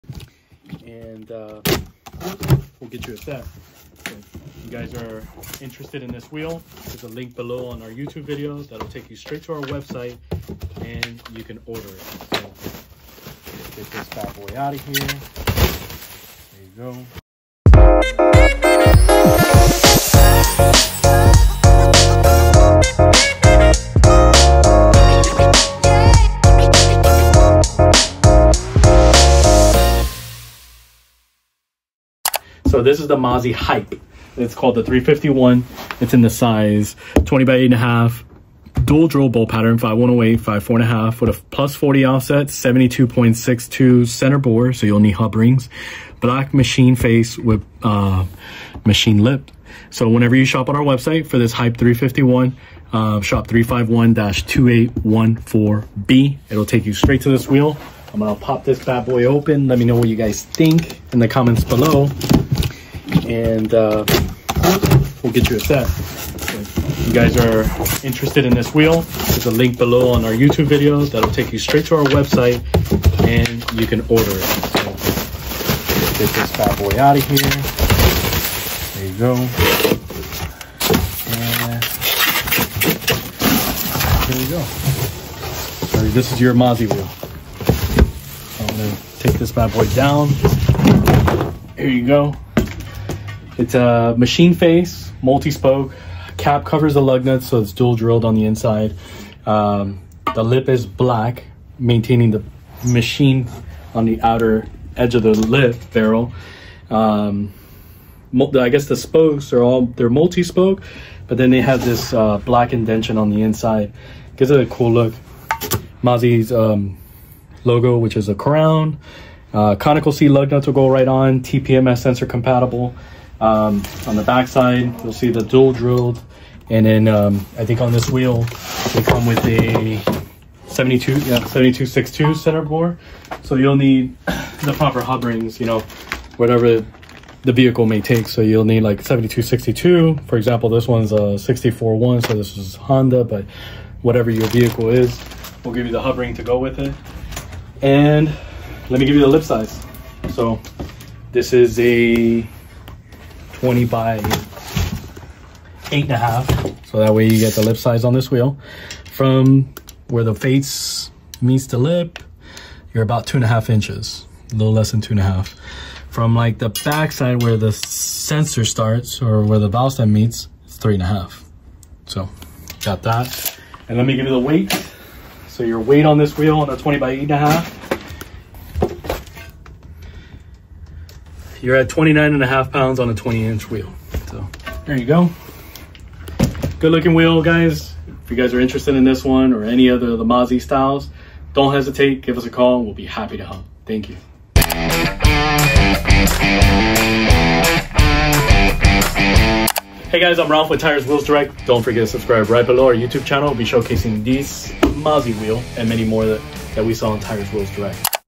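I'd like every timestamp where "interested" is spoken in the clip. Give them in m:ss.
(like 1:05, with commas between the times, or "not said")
0:05, 1:08, 3:08.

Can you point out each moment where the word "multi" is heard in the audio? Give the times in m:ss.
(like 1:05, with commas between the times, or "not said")
1:35, 1:50.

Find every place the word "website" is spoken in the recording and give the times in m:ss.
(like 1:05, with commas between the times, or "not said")
0:09, 0:50, 1:12.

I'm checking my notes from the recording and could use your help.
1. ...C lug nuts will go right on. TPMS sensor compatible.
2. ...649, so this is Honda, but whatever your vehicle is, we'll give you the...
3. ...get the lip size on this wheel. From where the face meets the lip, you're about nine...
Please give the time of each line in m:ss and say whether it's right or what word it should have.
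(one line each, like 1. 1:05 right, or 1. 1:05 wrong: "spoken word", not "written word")
1. 2:00 right
2. 2:21 wrong: "641", not "649"
3. 2:37 wrong: "two", not "nine".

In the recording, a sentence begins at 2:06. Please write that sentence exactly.
And then um, I think on this wheel, they come with a 72, yeah, 7262 center bore.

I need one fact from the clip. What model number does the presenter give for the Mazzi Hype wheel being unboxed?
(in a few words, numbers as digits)
351.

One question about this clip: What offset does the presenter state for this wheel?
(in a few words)
+40.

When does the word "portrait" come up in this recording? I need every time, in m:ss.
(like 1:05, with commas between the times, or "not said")
not said.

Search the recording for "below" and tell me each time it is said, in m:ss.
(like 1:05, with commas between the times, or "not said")
0:07, 1:01, 1:09, 3:22.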